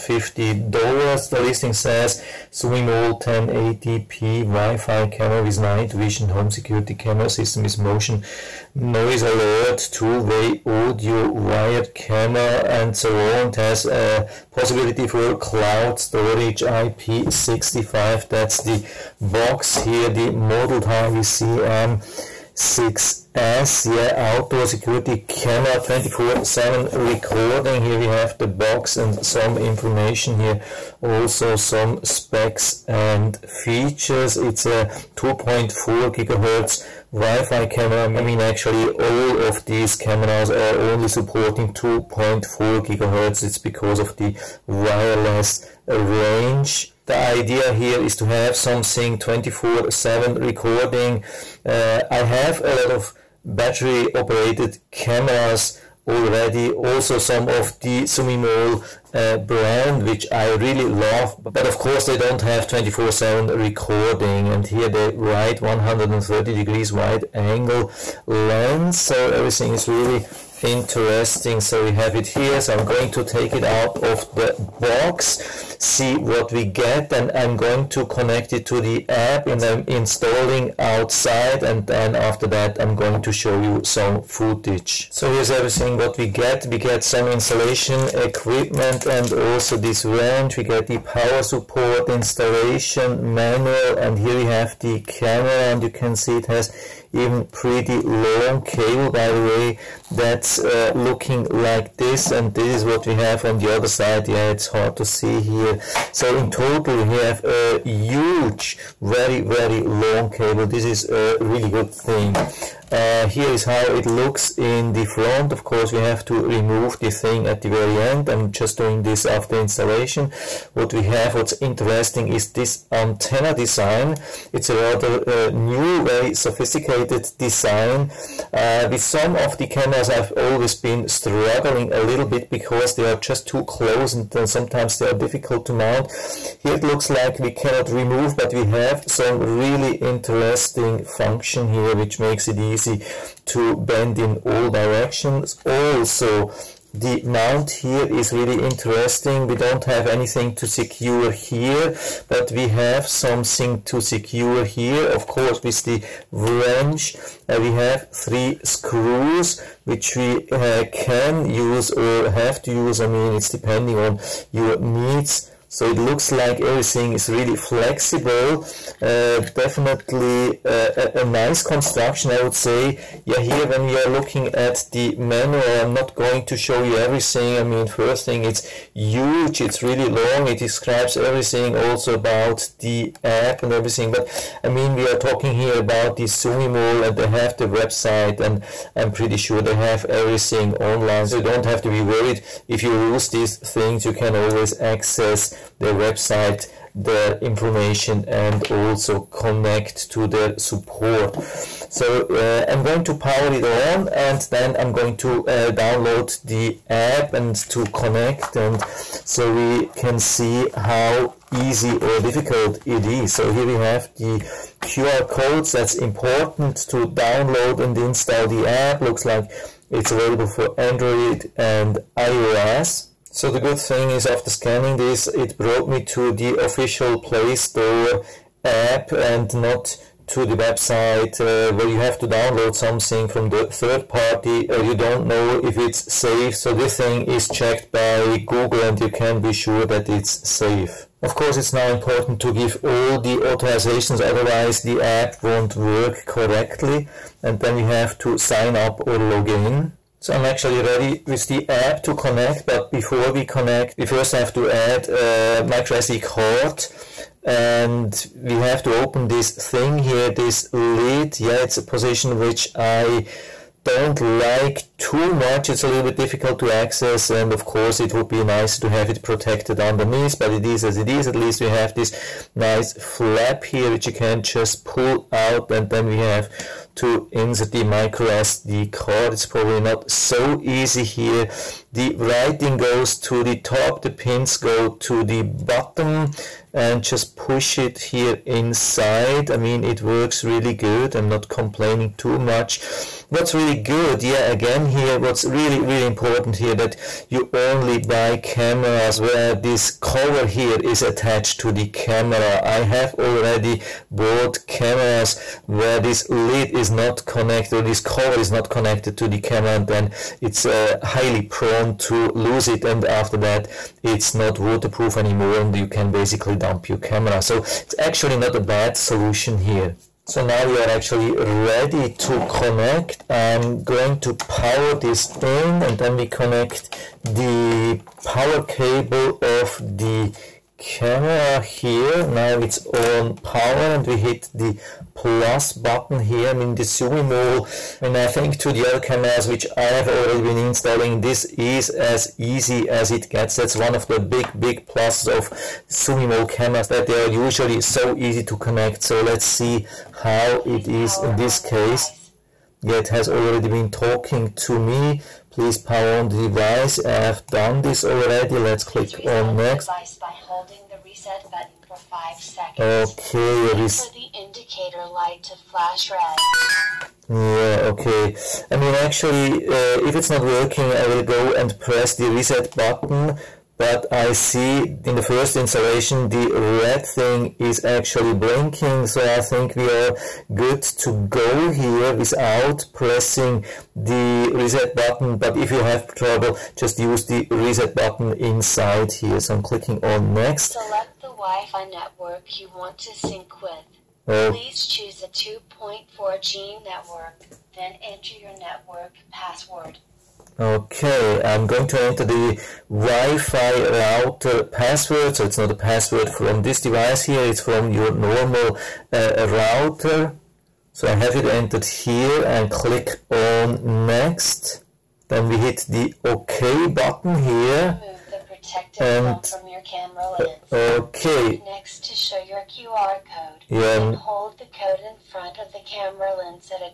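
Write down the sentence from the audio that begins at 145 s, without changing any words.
Also, the mount here is really interesting.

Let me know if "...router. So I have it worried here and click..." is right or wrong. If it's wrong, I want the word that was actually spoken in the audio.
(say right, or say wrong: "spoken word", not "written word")
wrong: "entered", not "worried".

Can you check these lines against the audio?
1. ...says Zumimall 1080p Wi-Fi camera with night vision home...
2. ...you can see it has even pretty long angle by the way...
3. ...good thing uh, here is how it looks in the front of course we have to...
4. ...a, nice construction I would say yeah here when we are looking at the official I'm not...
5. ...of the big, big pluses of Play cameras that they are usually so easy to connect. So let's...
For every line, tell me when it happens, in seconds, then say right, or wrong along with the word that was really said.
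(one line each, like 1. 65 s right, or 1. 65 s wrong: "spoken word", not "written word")
1. 1 s right
2. 95 s wrong: "cable", not "angle"
3. 111 s right
4. 171 s wrong: "manual", not "official"
5. 343 s wrong: "Zumimall", not "Play".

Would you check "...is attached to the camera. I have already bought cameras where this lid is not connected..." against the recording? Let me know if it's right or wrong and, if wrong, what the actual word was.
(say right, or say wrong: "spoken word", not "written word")
right.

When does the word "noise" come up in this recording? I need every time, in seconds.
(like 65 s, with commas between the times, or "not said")
8 s.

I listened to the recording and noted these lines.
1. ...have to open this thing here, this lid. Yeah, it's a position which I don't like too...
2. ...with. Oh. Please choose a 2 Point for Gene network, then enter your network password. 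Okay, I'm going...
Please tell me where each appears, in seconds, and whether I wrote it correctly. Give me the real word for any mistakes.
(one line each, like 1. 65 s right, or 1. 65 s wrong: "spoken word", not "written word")
1. 258 s right
2. 393 s right.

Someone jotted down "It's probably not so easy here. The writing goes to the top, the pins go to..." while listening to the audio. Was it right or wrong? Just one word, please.
right.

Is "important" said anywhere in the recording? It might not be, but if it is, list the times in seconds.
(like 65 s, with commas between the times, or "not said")
215 s, 241 s, 296 s.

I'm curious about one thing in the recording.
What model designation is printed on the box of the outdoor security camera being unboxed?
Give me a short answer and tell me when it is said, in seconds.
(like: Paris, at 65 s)
M6S, at 21 s.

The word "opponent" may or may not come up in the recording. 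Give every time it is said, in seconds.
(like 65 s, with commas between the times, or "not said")
not said.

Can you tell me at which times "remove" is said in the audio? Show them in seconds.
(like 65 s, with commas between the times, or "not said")
116 s, 137 s.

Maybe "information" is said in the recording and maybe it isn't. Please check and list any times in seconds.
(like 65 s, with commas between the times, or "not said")
29 s, 197 s.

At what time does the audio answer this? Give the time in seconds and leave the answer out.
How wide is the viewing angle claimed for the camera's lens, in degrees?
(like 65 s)
65 s.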